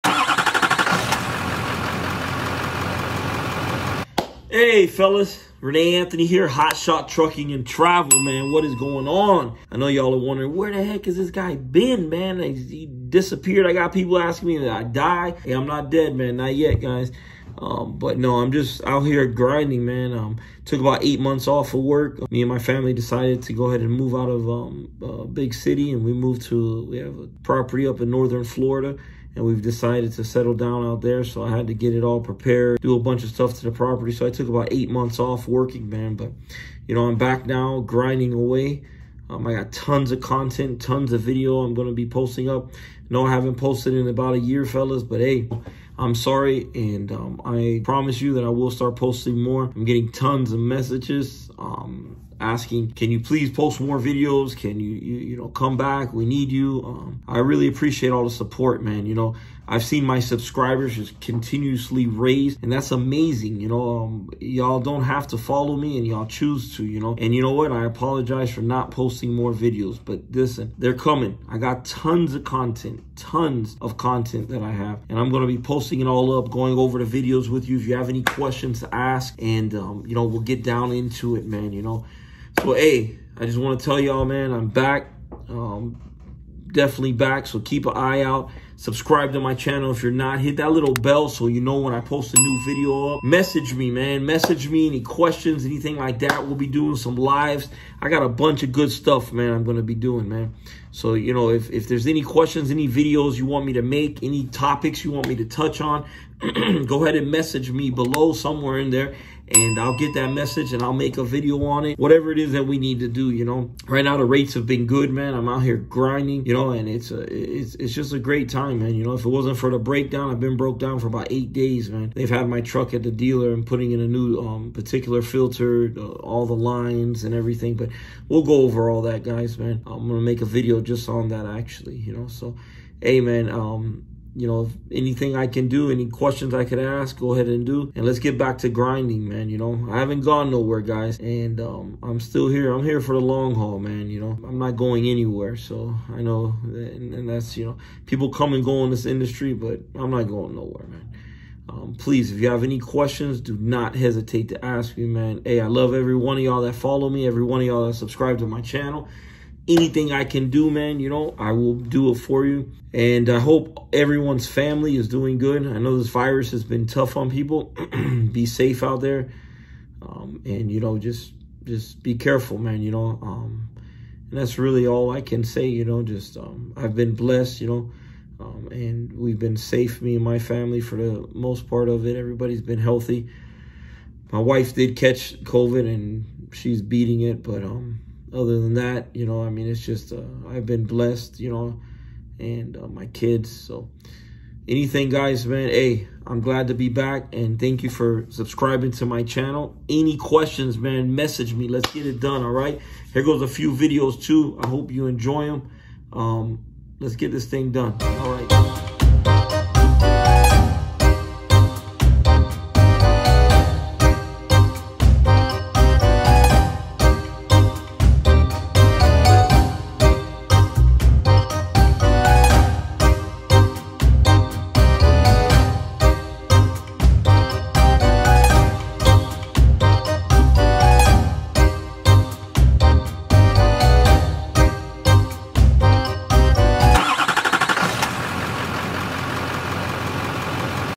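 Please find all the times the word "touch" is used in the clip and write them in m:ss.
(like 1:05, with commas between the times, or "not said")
1:45.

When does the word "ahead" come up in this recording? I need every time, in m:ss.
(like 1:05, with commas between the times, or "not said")
0:23, 1:47, 2:17.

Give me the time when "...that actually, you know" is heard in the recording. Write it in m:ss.
2:11.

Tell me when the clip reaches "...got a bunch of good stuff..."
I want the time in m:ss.
1:38.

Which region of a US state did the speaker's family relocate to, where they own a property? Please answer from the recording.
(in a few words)
Northern Florida.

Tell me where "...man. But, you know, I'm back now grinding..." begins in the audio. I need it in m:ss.
0:35.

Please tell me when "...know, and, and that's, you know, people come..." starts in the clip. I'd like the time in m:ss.
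2:26.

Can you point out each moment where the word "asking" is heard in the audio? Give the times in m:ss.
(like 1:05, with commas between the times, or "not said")
0:14, 0:52.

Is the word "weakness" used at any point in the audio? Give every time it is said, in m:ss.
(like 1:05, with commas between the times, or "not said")
not said.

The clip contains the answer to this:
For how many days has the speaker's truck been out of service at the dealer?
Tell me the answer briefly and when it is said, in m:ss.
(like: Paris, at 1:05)
8 days, at 2:01.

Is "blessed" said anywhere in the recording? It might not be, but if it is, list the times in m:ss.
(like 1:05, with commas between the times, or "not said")
2:57, 3:10.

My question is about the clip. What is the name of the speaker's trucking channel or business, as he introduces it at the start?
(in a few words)
Hot Shot Trucking and Travel.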